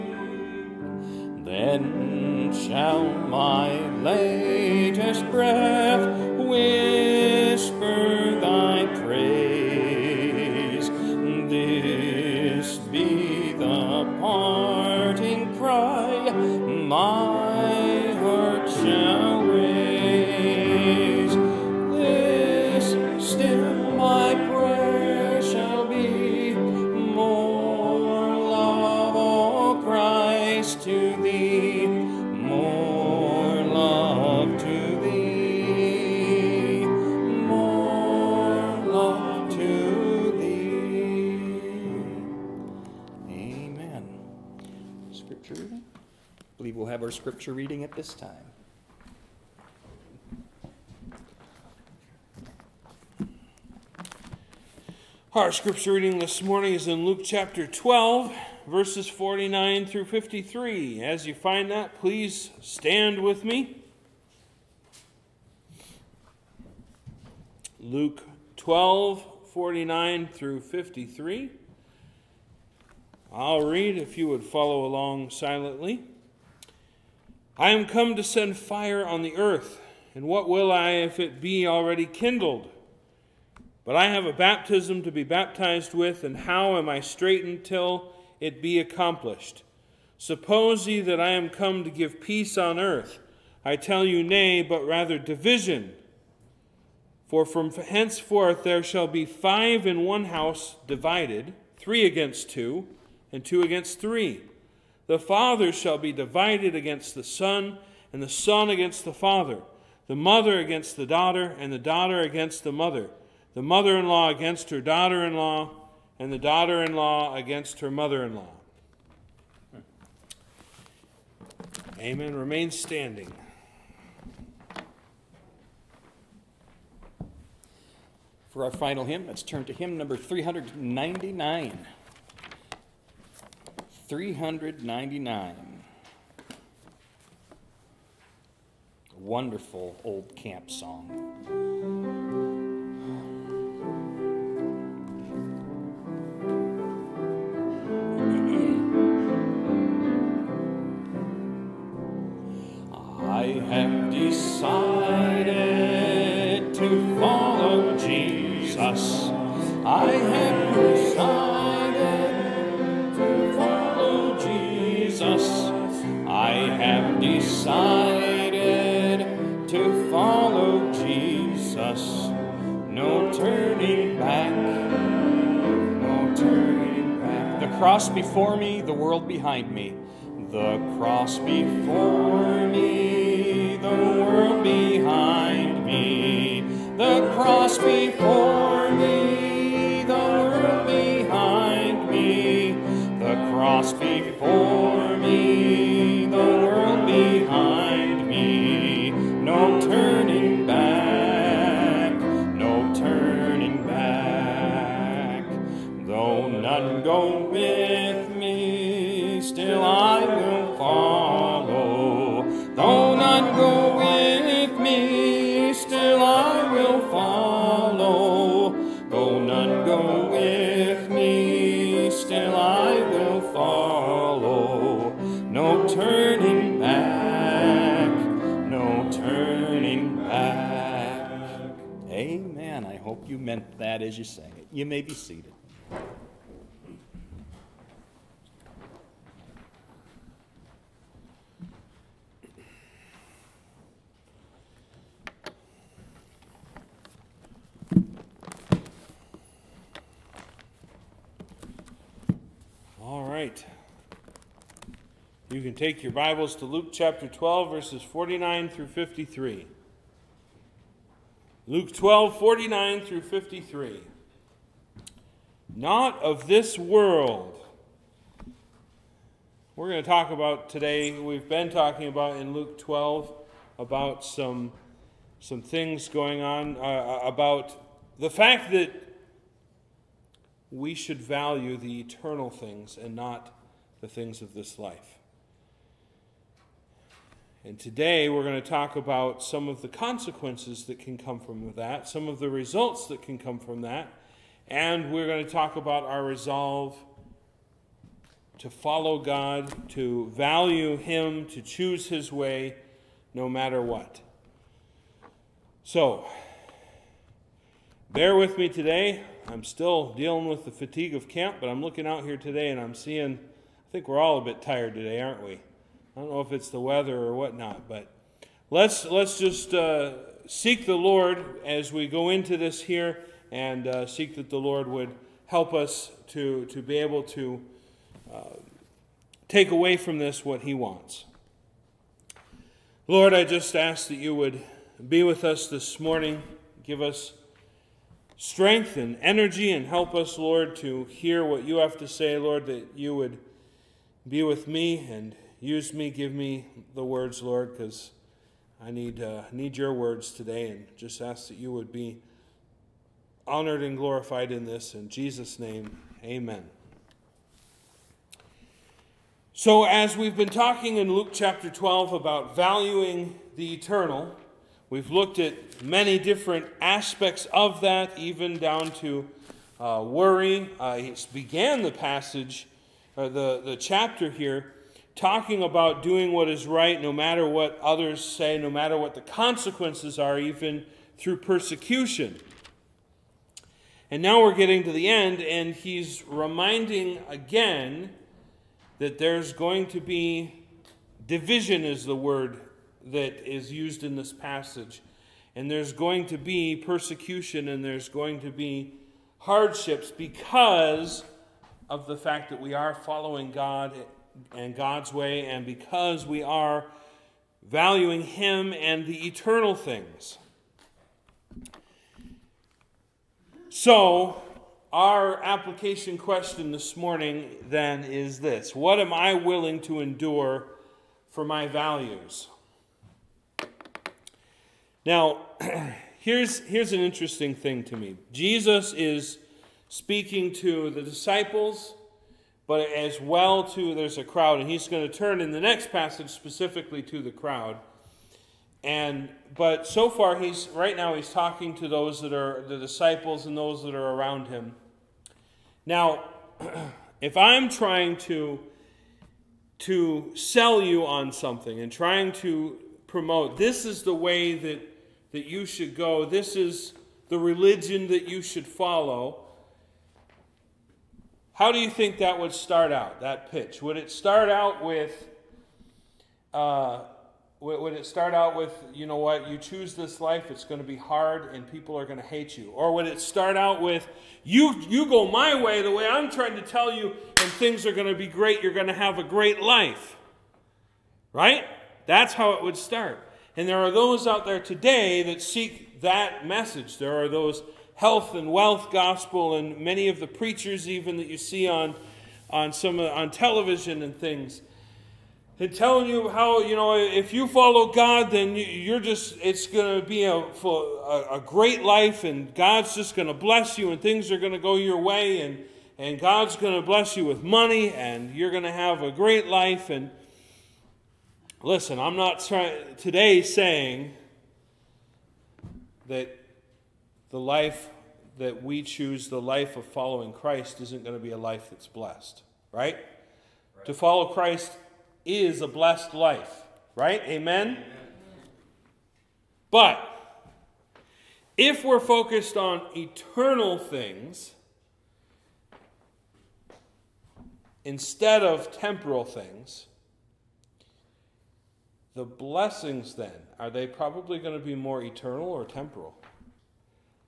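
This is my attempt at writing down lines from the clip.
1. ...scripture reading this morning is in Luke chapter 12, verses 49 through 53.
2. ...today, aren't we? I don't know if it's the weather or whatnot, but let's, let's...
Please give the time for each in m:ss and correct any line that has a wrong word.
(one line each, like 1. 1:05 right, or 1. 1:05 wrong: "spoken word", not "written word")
1. 0:55 right
2. 5:14 right.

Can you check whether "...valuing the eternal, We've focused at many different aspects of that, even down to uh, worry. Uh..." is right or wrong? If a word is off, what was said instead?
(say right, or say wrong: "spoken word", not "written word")
wrong: "looked", not "focused".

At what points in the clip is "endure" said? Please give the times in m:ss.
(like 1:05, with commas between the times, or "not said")
7:00.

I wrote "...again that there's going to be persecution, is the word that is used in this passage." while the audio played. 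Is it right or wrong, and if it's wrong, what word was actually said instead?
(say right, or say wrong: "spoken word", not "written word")
wrong: "division", not "persecution".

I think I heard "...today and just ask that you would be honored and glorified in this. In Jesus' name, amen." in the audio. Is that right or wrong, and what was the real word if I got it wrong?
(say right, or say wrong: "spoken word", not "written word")
right.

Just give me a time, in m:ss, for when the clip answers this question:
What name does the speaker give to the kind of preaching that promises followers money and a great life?
8:07.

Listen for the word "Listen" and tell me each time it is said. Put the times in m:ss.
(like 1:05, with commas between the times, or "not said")
8:31.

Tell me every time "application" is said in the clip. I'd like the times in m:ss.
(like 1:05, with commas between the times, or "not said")
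6:55.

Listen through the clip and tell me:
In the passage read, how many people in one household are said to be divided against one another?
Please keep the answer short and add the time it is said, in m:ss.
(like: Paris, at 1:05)
5, at 1:39.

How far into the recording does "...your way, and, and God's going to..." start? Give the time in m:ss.
8:24.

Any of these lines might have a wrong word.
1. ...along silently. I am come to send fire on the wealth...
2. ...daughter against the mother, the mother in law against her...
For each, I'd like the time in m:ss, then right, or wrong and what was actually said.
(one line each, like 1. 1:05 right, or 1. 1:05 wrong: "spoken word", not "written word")
1. 1:14 wrong: "earth", not "wealth"
2. 1:51 right.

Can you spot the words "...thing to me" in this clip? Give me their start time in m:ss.
7:07.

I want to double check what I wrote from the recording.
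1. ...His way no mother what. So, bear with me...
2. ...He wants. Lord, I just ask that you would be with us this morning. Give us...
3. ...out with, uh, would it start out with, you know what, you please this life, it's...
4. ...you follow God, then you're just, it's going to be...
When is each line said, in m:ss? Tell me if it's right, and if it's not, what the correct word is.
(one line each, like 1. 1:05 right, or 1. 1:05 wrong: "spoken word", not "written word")
1. 5:02 wrong: "matter", not "mother"
2. 5:30 right
3. 7:44 wrong: "choose", not "please"
4. 8:17 right.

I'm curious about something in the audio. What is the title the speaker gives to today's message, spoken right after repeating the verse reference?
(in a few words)
Not of this world.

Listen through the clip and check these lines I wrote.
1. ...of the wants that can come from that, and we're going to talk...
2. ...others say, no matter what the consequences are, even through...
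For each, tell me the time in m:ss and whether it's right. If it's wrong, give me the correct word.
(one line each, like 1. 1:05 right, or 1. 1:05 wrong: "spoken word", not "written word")
1. 4:52 wrong: "results", not "wants"
2. 6:17 right.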